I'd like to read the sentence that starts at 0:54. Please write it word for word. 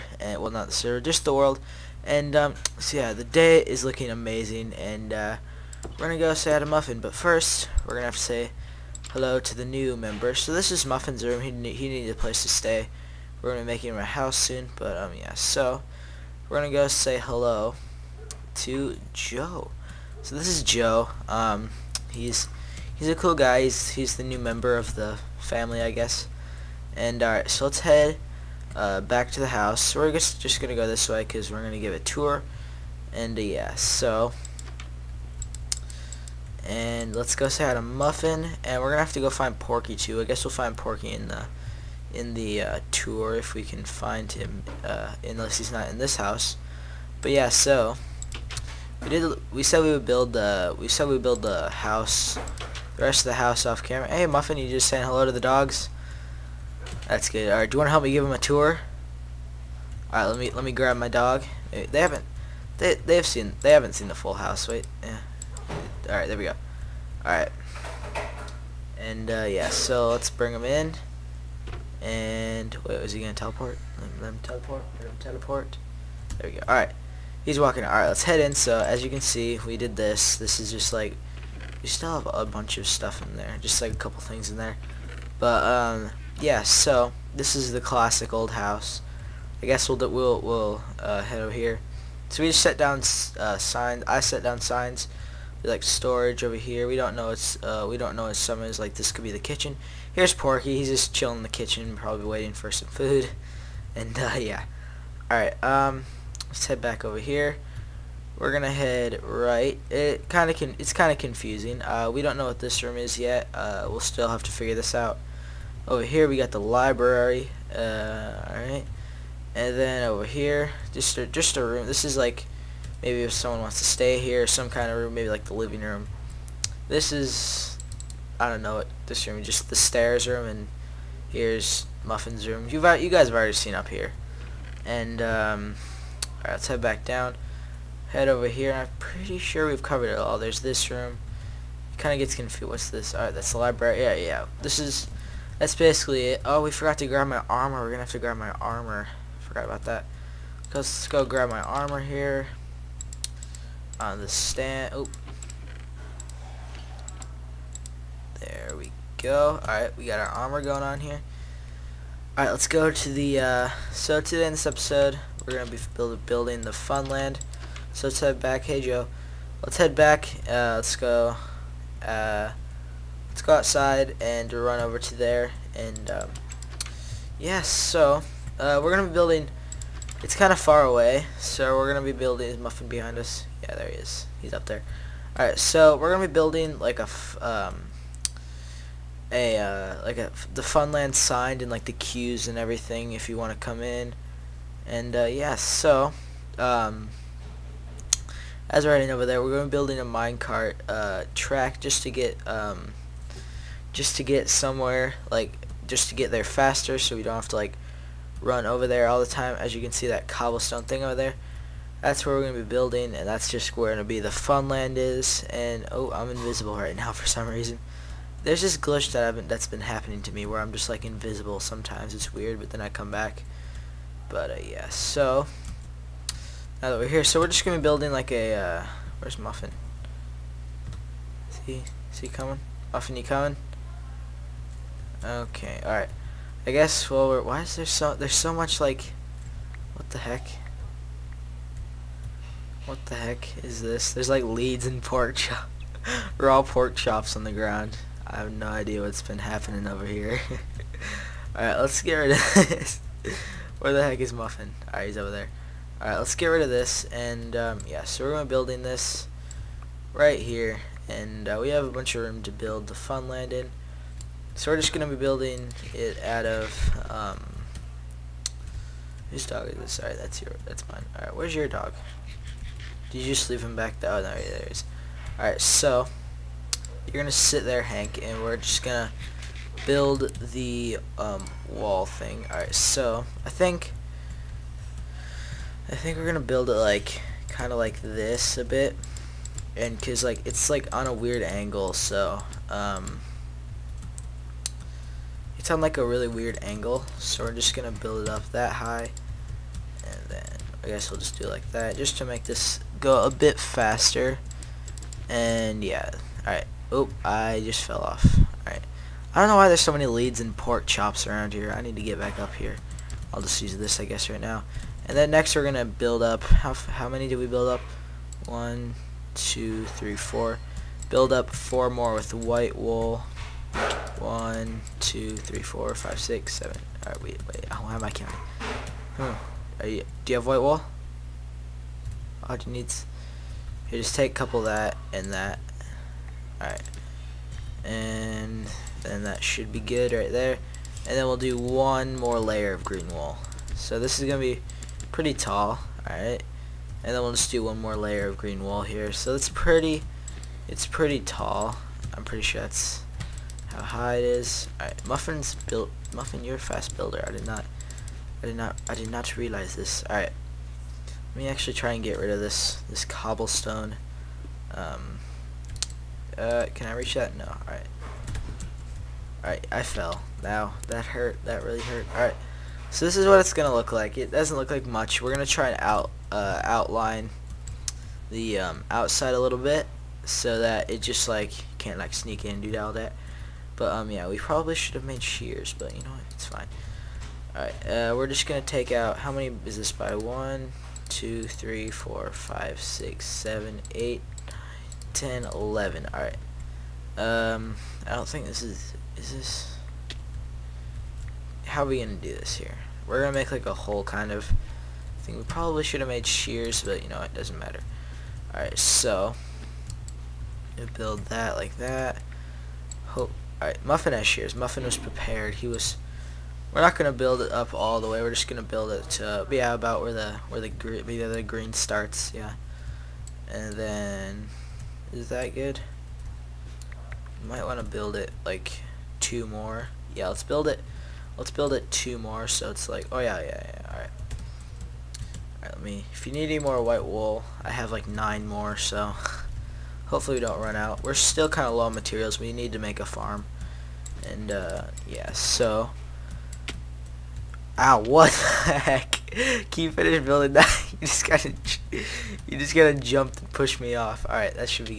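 Hey, Muffin, you just saying hello to the dogs?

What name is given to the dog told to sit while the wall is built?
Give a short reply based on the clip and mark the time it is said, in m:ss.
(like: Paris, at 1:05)
Hank, at 4:37.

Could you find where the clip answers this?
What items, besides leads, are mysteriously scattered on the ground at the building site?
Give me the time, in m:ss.
4:06.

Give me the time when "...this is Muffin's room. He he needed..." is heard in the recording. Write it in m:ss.
0:10.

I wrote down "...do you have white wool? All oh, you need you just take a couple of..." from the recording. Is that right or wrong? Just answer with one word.
right.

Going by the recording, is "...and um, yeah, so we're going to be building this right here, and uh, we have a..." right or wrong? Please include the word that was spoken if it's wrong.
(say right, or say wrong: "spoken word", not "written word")
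right.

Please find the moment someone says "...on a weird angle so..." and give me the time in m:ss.
4:50.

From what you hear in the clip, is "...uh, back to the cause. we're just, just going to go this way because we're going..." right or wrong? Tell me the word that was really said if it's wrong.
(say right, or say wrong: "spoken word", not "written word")
wrong: "house", not "cause".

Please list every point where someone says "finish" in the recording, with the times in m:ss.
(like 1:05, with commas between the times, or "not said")
7:29.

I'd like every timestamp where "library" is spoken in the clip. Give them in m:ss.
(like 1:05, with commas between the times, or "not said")
1:56, 2:23.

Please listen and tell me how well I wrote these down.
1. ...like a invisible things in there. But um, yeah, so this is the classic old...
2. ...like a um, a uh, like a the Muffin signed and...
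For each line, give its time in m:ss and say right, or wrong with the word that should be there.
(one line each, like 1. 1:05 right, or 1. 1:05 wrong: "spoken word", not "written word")
1. 1:23 wrong: "couple", not "invisible"
2. 3:06 wrong: "Funland", not "Muffin".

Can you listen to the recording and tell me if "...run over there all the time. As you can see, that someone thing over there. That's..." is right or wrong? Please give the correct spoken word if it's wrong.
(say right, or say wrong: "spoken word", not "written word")
wrong: "cobblestone", not "someone".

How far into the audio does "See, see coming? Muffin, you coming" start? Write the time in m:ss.
3:51.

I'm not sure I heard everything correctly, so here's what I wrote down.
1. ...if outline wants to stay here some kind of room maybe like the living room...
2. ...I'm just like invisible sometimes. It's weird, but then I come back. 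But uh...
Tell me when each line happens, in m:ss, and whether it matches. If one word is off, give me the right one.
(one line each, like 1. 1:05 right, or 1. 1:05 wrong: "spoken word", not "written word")
1. 2:03 wrong: "someone", not "outline"
2. 3:40 right.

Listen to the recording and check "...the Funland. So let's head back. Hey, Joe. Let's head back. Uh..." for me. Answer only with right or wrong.
right.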